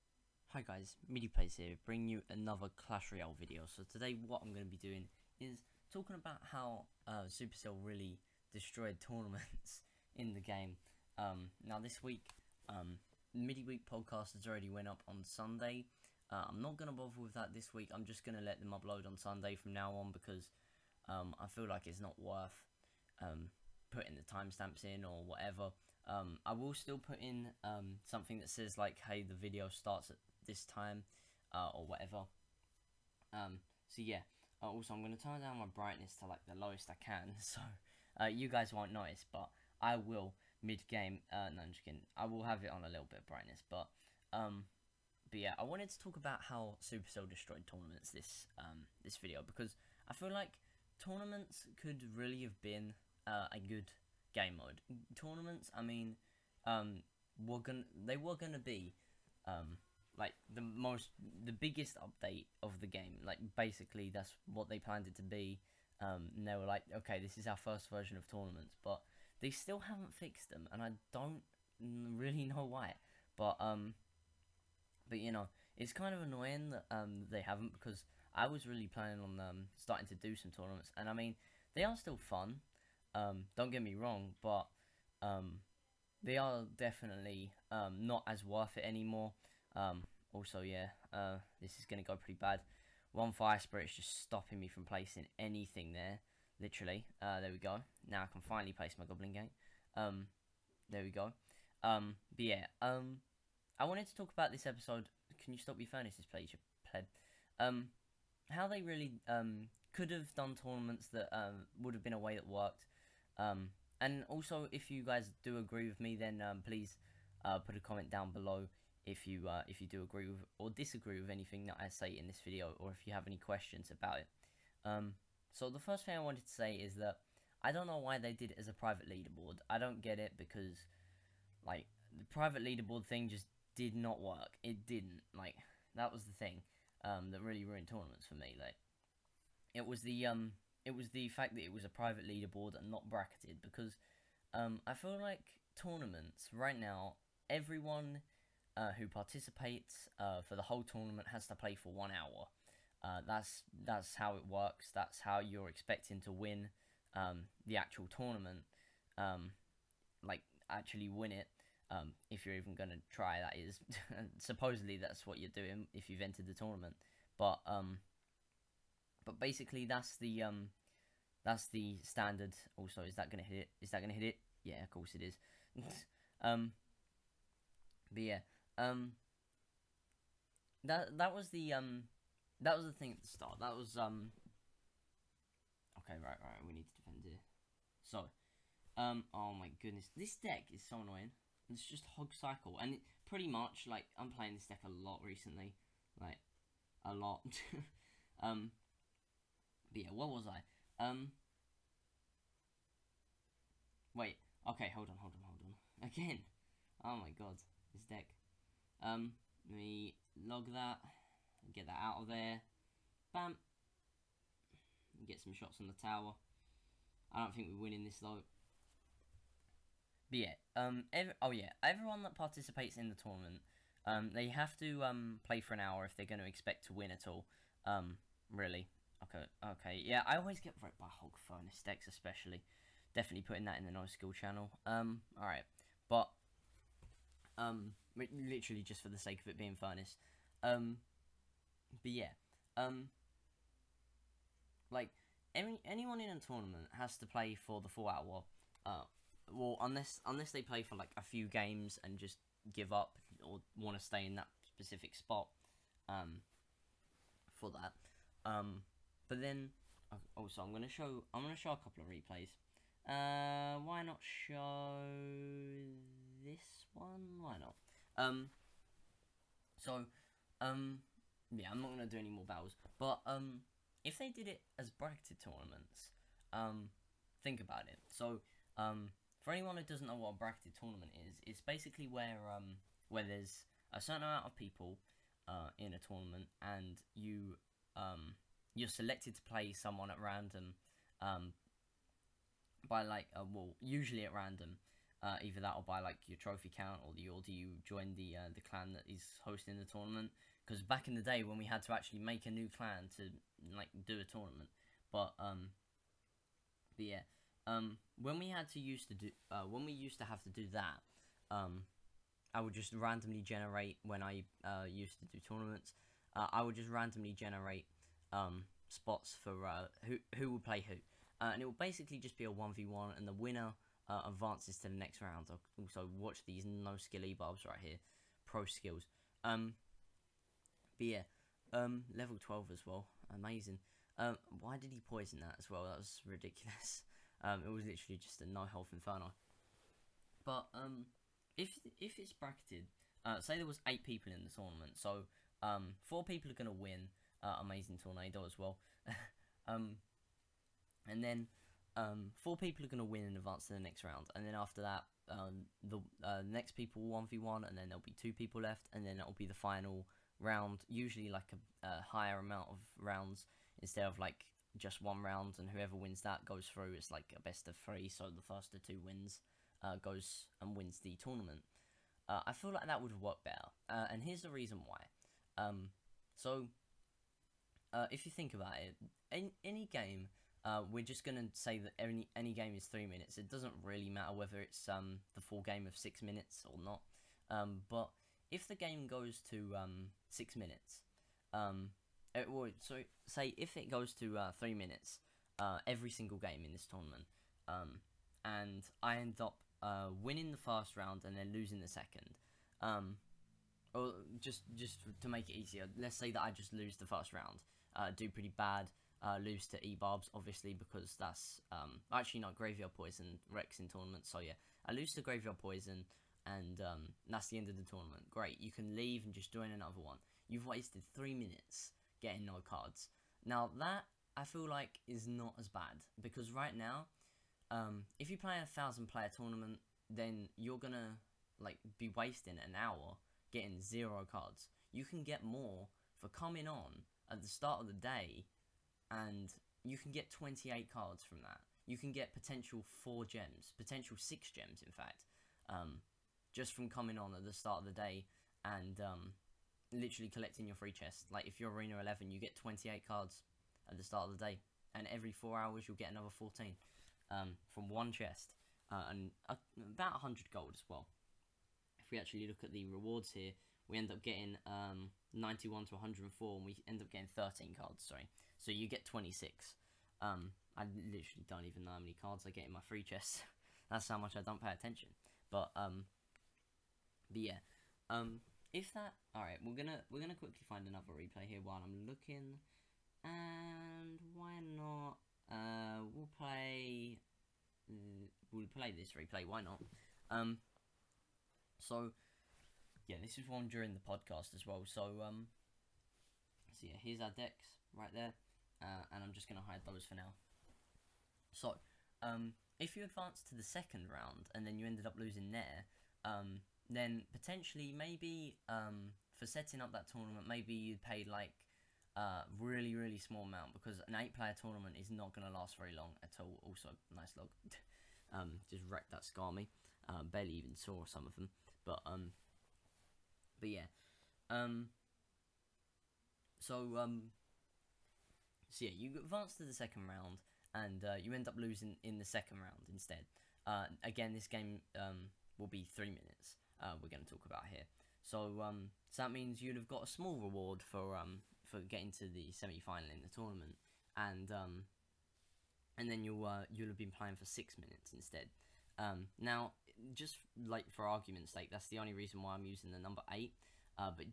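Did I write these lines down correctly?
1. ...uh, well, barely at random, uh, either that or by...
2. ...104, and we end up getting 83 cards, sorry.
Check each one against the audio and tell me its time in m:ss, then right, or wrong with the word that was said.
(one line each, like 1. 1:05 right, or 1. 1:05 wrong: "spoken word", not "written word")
1. 4:53 wrong: "usually", not "barely"
2. 7:45 wrong: "13", not "83".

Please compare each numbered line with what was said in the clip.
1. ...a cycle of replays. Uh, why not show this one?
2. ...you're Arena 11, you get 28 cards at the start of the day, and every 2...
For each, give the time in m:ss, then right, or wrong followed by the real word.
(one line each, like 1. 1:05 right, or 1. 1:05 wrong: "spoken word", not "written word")
1. 4:21 wrong: "couple", not "cycle"
2. 7:31 wrong: "4", not "2".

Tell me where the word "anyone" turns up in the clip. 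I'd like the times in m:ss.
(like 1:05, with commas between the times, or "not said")
4:05, 4:39.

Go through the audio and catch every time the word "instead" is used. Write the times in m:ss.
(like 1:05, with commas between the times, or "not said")
6:03, 8:52, 9:08.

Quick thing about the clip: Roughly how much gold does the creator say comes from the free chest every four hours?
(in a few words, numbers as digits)
100.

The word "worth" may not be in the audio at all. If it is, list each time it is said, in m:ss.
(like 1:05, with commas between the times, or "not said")
0:22, 1:28.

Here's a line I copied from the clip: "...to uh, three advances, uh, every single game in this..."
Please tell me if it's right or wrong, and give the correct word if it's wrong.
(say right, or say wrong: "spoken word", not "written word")
wrong: "minutes", not "advances".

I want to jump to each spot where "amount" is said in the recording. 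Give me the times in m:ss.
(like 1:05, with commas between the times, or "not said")
4:44, 6:02, 8:33.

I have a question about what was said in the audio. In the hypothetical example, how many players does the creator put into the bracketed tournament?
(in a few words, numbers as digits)
8.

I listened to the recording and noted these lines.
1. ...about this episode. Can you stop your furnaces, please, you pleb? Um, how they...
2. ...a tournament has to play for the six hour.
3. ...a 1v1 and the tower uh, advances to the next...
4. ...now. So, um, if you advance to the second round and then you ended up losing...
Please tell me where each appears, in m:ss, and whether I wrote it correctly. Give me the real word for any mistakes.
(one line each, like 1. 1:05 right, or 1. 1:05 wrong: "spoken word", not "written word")
1. 1:44 right
2. 4:06 wrong: "four", not "six"
3. 5:22 wrong: "winner", not "tower"
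4. 8:20 right.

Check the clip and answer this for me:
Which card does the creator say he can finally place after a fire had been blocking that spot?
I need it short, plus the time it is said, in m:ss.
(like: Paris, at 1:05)
goblin gate, at 1:39.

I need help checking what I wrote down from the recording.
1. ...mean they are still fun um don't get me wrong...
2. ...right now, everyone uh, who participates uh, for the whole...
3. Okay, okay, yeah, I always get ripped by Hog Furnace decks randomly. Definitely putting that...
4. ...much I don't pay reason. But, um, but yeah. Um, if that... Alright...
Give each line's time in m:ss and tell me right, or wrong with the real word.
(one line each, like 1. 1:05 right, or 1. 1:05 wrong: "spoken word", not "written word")
1. 1:21 right
2. 2:26 right
3. 3:49 wrong: "especially", not "randomly"
4. 7:54 wrong: "attention", not "reason".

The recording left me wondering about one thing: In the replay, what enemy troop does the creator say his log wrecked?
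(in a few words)
Skarmy.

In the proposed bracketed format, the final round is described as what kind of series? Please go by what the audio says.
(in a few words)
best of three.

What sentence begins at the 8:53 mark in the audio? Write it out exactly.
Uh, again, this game um, will be three minutes.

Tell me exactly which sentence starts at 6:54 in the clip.
So yeah, I lose to Graveyard Poison, and um, that's the end of the tournament.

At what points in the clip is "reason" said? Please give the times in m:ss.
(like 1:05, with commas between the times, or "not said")
6:14, 9:12.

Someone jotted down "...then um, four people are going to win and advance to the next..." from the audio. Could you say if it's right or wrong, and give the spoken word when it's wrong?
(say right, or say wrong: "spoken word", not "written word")
right.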